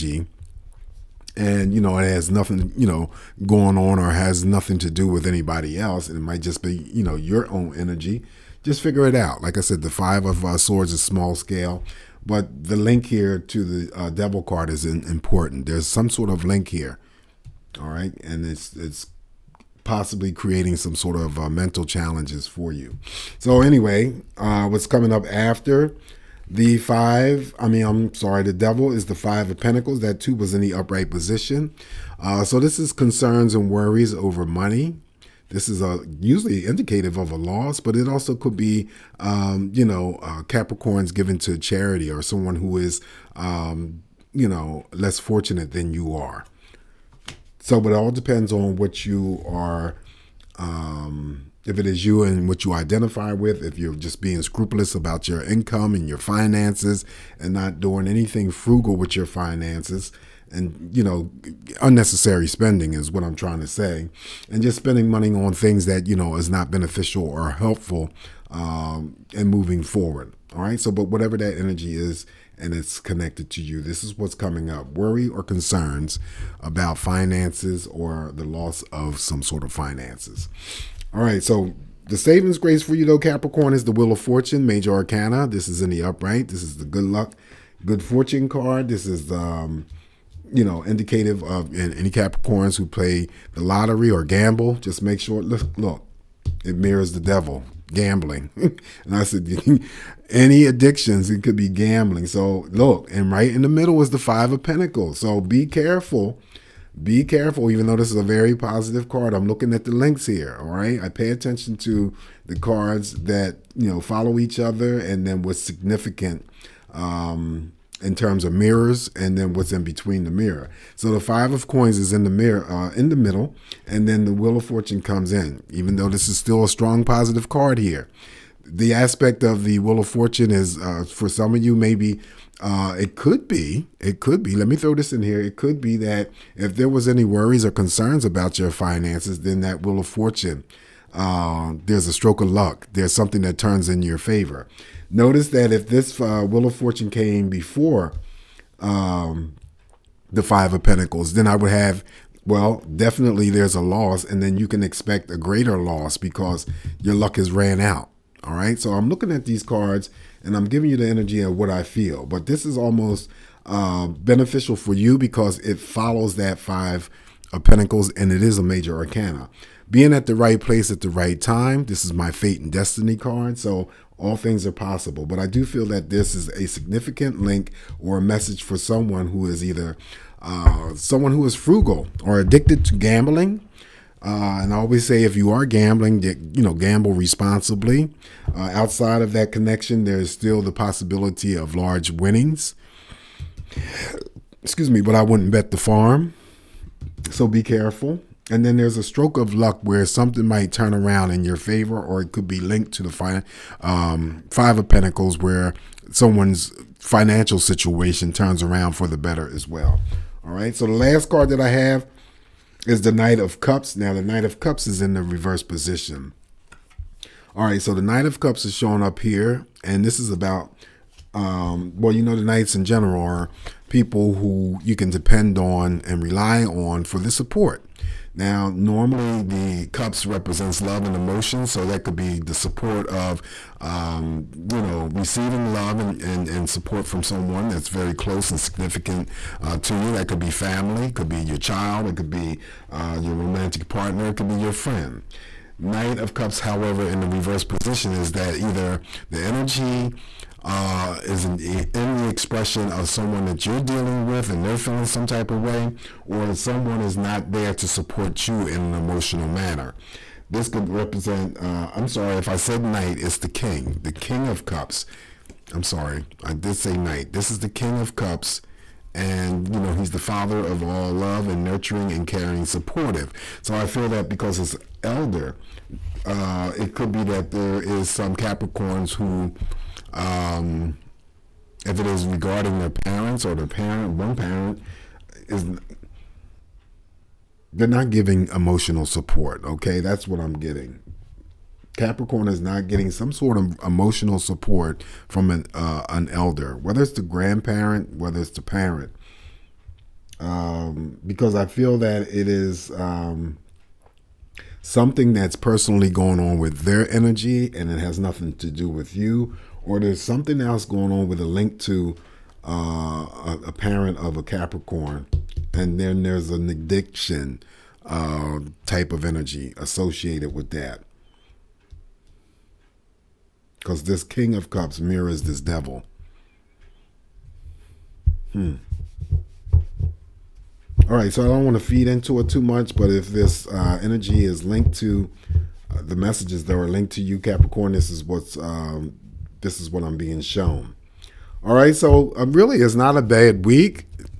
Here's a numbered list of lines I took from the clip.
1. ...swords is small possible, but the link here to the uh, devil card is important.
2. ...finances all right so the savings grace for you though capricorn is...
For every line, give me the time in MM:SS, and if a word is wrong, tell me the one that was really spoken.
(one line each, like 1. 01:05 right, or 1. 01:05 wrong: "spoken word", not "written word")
1. 00:10 wrong: "scale", not "possible"
2. 01:19 right.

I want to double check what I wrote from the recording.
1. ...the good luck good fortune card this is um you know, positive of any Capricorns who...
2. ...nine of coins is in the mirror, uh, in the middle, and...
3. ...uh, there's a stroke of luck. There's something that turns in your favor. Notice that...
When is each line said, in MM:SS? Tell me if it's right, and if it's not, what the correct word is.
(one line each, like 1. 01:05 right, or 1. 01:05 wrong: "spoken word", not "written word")
1. 01:26 wrong: "indicative", not "positive"
2. 02:01 wrong: "five", not "nine"
3. 02:21 right.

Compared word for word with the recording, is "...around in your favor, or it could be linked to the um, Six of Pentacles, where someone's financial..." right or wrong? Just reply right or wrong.
wrong.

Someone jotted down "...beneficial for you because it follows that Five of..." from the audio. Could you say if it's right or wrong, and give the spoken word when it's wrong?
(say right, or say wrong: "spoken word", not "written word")
right.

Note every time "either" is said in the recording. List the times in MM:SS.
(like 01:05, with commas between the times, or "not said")
02:59, 04:08.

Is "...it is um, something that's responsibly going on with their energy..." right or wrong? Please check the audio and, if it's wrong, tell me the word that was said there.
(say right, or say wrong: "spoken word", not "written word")
wrong: "personally", not "responsibly".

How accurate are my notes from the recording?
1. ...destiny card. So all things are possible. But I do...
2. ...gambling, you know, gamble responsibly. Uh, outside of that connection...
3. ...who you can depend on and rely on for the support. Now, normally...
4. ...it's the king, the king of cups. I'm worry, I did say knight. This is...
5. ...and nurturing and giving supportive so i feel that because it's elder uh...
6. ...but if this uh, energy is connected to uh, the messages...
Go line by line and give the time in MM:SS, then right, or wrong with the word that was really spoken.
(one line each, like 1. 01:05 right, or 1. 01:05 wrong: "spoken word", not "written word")
1. 02:52 right
2. 03:05 right
3. 03:44 right
4. 04:23 wrong: "sorry", not "worry"
5. 04:31 wrong: "caring", not "giving"
6. 05:32 wrong: "linked", not "connected".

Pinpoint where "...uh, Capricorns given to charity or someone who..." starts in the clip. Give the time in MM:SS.
00:40.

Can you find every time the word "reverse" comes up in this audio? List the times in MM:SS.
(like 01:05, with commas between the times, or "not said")
03:35, 04:07.